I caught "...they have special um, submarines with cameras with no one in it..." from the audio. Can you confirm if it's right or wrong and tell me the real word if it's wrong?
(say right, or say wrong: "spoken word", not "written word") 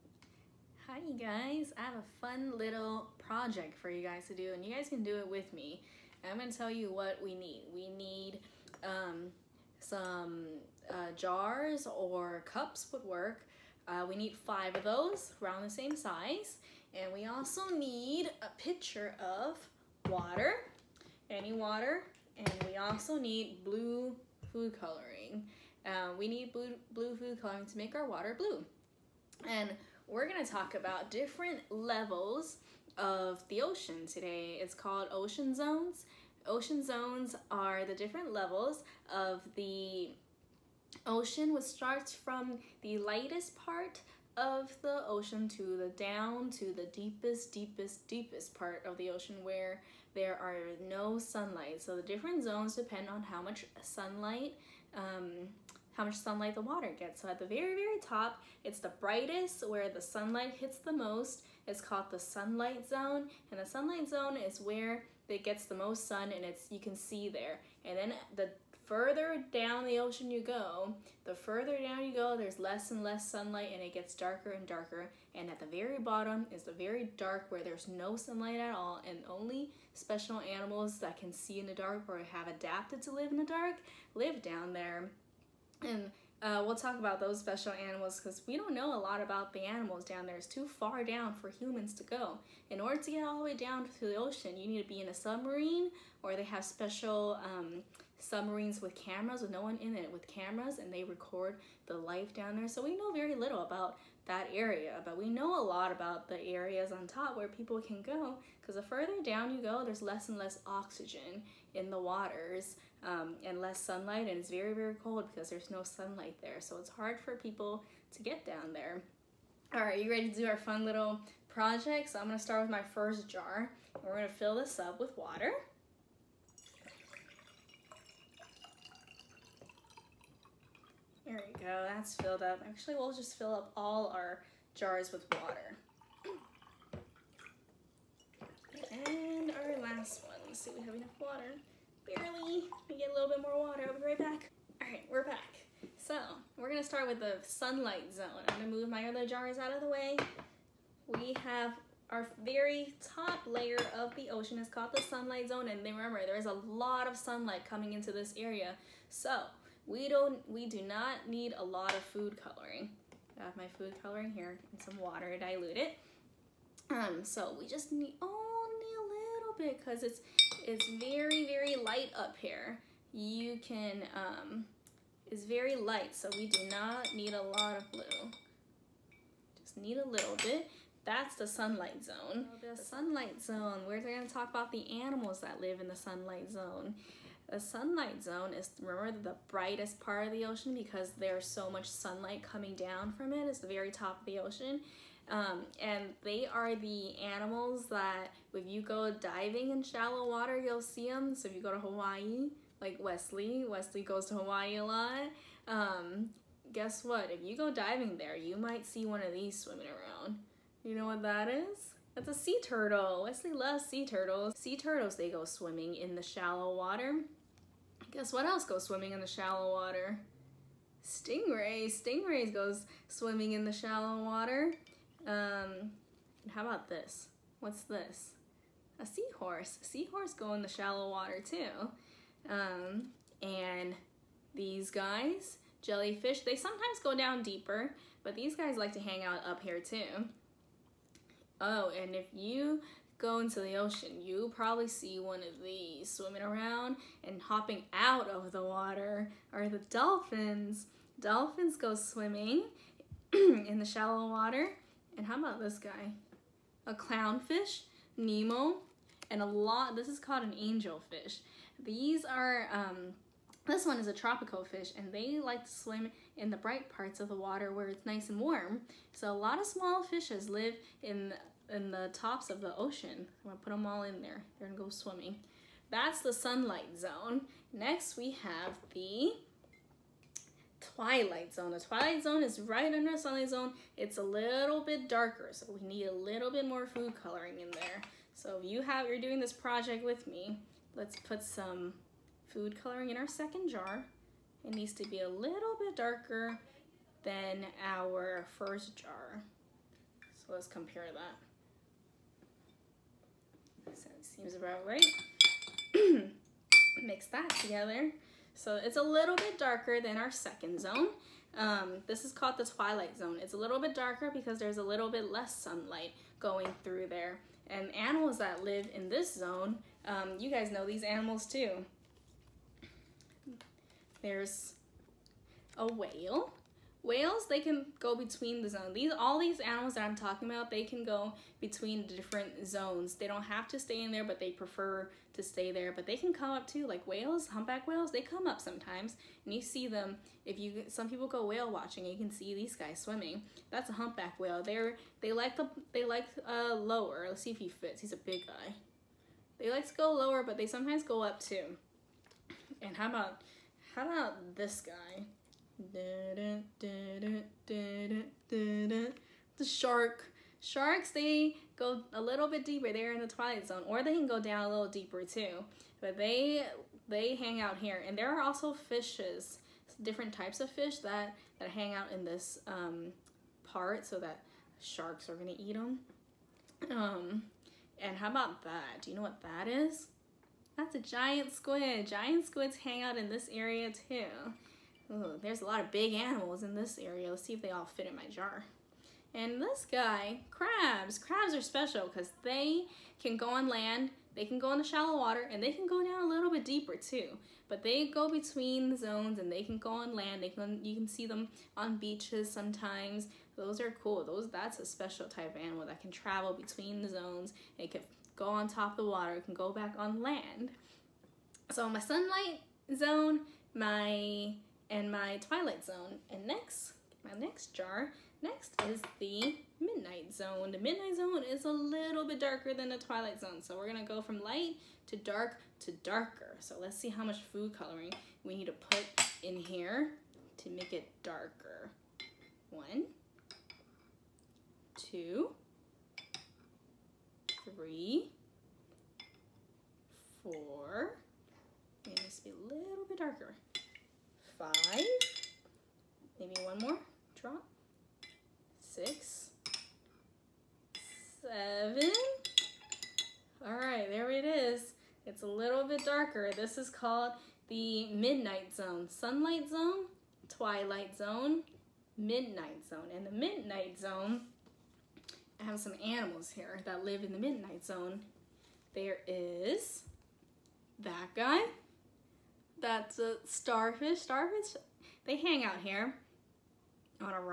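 right.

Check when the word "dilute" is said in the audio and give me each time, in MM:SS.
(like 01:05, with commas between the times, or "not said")
02:45.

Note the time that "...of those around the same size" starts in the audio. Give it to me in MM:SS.
00:14.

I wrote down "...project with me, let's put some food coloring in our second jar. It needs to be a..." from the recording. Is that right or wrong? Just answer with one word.
right.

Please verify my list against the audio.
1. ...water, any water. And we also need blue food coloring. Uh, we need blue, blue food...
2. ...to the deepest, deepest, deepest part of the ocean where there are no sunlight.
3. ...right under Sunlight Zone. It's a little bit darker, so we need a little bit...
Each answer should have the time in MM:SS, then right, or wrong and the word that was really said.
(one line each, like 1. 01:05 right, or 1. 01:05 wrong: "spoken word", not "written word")
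1. 00:20 right
2. 00:46 right
3. 04:42 right.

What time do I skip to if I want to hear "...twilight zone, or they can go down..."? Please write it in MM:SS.
06:03.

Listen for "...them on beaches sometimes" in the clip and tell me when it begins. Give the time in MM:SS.
06:41.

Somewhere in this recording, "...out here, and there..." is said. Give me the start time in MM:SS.
06:07.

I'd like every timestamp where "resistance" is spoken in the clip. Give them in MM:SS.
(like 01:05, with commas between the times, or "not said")
not said.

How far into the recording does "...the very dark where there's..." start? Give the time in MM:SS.
01:16.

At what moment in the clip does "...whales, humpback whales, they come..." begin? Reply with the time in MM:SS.
05:37.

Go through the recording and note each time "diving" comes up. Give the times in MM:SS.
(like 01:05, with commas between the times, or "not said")
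03:19, 03:27.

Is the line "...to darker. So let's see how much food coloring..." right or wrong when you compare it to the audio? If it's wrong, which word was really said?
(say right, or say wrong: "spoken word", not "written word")
right.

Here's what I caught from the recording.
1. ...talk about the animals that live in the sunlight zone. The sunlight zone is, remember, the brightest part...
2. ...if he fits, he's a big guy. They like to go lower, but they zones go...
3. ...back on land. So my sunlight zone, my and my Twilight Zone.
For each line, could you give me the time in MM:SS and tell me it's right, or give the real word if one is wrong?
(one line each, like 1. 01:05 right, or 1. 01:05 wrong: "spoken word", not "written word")
1. 03:04 right
2. 05:47 wrong: "sometimes", not "zones"
3. 06:49 right.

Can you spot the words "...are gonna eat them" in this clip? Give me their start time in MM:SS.
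06:15.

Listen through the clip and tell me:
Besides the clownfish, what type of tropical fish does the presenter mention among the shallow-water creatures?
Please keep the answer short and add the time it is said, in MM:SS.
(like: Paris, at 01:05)
Angelfish, at 04:20.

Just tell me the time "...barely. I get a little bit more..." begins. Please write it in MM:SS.
02:22.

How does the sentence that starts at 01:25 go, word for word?
And uh, we'll talk about those special animals because we don't know a lot about the animals down there.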